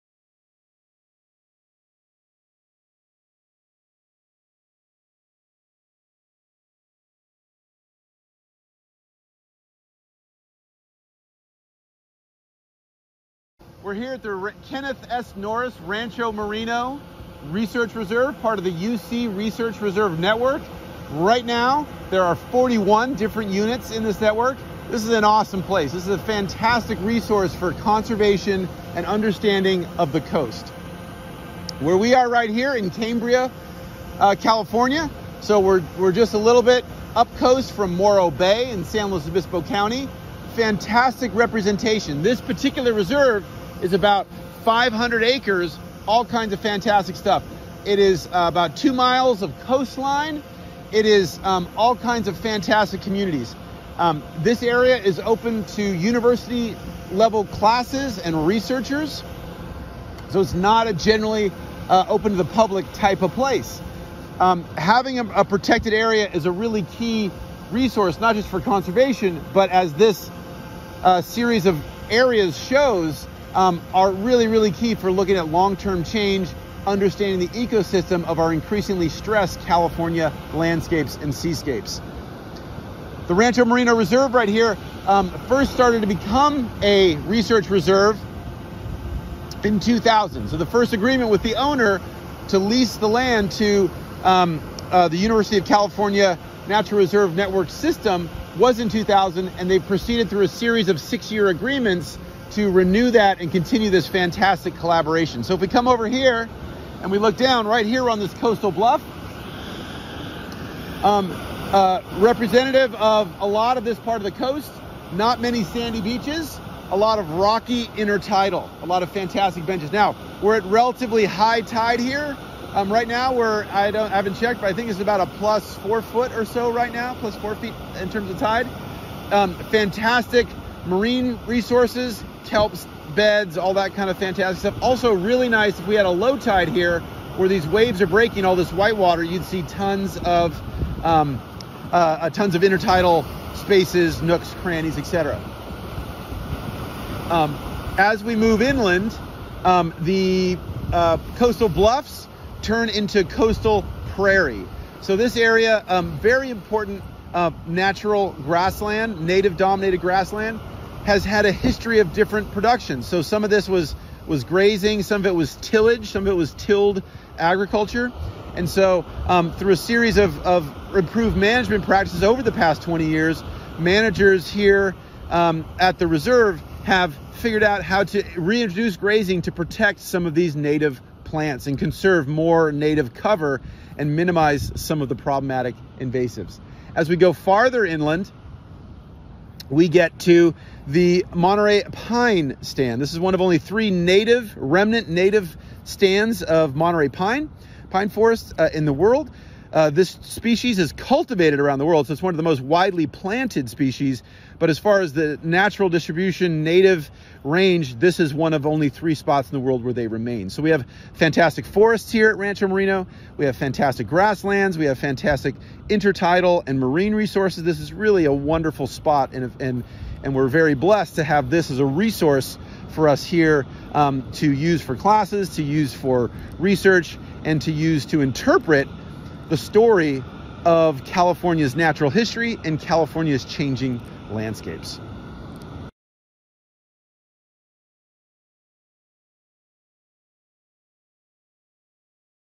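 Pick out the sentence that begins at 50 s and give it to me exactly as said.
It is um, all kinds of fantastic communities.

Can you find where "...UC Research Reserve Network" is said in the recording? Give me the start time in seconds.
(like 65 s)
18 s.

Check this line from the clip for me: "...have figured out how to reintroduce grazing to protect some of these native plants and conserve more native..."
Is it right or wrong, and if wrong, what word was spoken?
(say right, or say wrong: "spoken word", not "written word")
right.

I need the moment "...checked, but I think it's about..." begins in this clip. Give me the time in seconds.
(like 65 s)
124 s.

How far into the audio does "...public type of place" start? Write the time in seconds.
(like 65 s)
62 s.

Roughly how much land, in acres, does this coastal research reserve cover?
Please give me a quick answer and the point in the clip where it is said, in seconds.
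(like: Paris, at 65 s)
about 500 acres, at 43 s.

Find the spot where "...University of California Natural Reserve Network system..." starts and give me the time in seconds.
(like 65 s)
95 s.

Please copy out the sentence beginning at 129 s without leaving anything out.
Um, fantastic marine resources, kelps, beds, all that kind of fantastic stuff.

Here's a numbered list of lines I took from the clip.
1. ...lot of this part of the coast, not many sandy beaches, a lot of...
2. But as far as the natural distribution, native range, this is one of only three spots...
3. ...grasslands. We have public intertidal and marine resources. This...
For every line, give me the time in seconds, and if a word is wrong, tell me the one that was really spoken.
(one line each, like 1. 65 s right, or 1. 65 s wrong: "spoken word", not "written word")
1. 113 s right
2. 204 s right
3. 214 s wrong: "fantastic", not "public".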